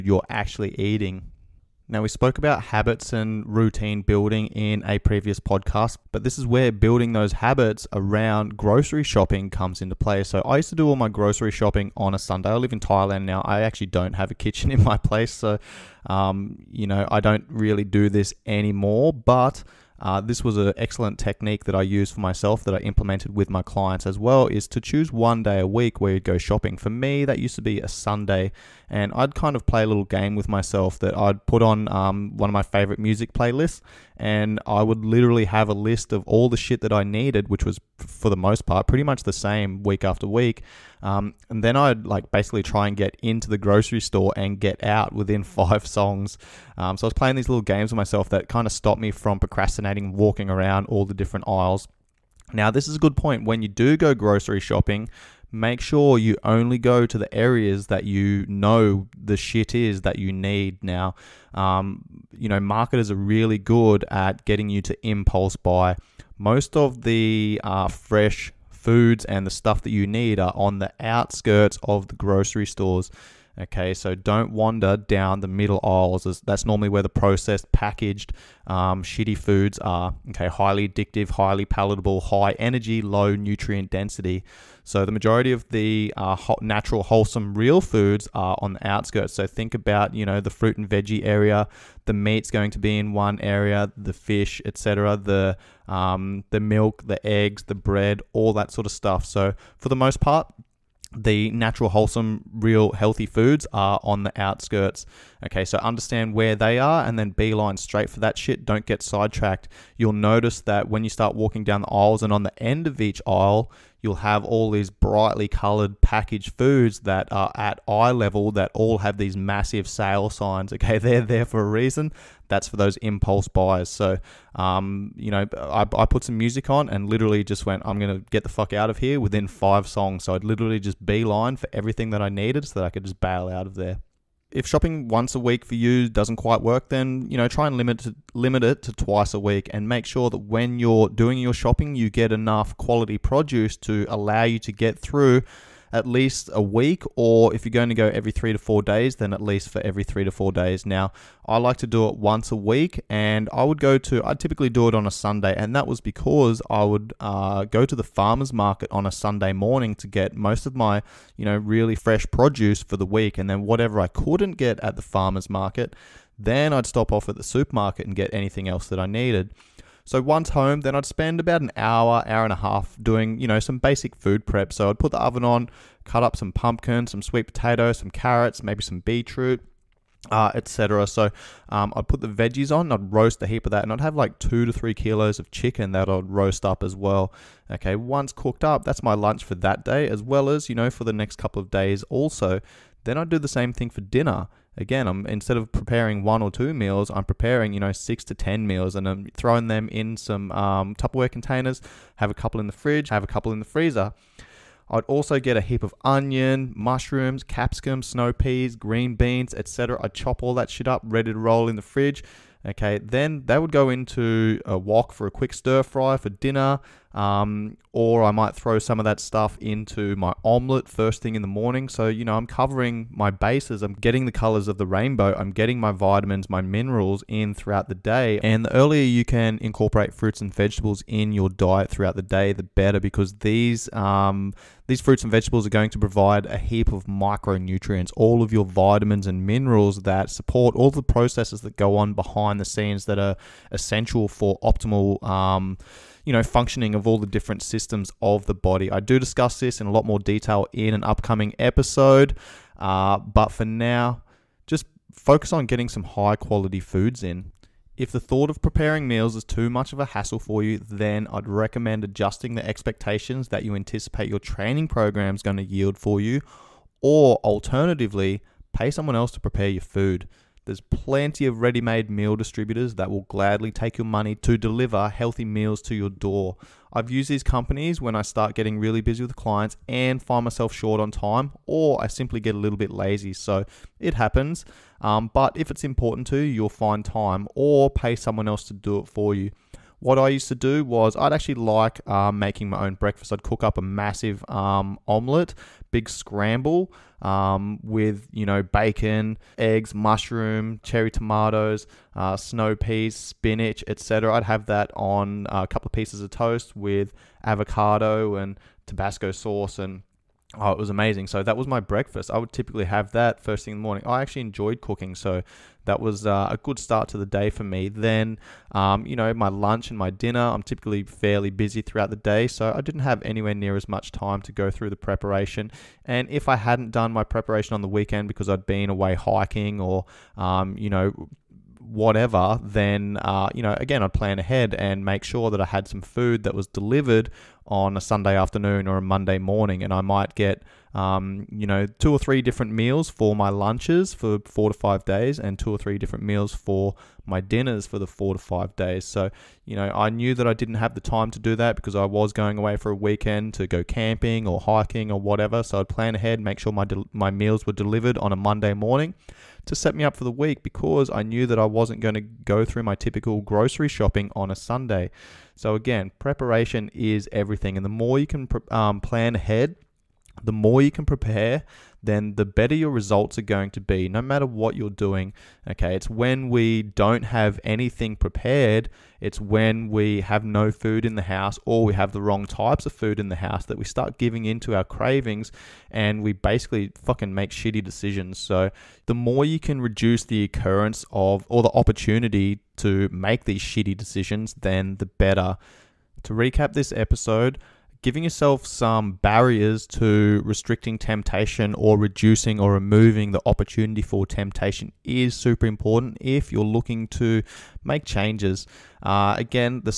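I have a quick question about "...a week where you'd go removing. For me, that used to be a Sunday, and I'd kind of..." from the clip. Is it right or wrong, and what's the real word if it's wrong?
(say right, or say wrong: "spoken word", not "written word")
wrong: "shopping", not "removing".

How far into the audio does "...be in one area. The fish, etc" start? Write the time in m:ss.
1:32.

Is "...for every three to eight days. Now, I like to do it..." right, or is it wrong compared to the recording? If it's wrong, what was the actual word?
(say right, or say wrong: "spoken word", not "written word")
wrong: "four", not "eight".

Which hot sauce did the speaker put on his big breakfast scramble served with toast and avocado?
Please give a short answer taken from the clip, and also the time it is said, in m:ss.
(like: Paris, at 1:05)
Tabasco, at 5:08.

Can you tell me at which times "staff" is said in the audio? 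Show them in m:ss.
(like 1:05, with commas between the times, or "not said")
not said.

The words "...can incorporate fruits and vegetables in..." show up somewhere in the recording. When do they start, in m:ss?
3:49.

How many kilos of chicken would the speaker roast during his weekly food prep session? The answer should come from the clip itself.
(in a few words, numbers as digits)
2 to 3.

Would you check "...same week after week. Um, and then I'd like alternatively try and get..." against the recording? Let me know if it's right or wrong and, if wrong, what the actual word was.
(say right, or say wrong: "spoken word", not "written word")
wrong: "basically", not "alternatively".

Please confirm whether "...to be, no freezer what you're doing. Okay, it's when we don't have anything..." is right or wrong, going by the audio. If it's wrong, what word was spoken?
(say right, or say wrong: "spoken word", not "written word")
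wrong: "matter", not "freezer".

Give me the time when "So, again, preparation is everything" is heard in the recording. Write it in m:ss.
6:05.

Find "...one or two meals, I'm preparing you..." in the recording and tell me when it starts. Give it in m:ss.
3:16.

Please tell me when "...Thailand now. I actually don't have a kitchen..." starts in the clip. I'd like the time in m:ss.
0:12.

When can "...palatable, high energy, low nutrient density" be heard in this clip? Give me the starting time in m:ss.
1:21.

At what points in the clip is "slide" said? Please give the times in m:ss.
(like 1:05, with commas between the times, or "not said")
not said.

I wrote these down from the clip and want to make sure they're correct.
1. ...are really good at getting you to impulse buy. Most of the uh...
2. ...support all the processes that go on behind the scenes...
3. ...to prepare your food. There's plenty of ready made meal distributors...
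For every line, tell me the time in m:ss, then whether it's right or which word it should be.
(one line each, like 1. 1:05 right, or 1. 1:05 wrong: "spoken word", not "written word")
1. 1:03 right
2. 4:00 right
3. 4:29 right.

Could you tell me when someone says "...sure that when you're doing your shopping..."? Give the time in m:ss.
2:20.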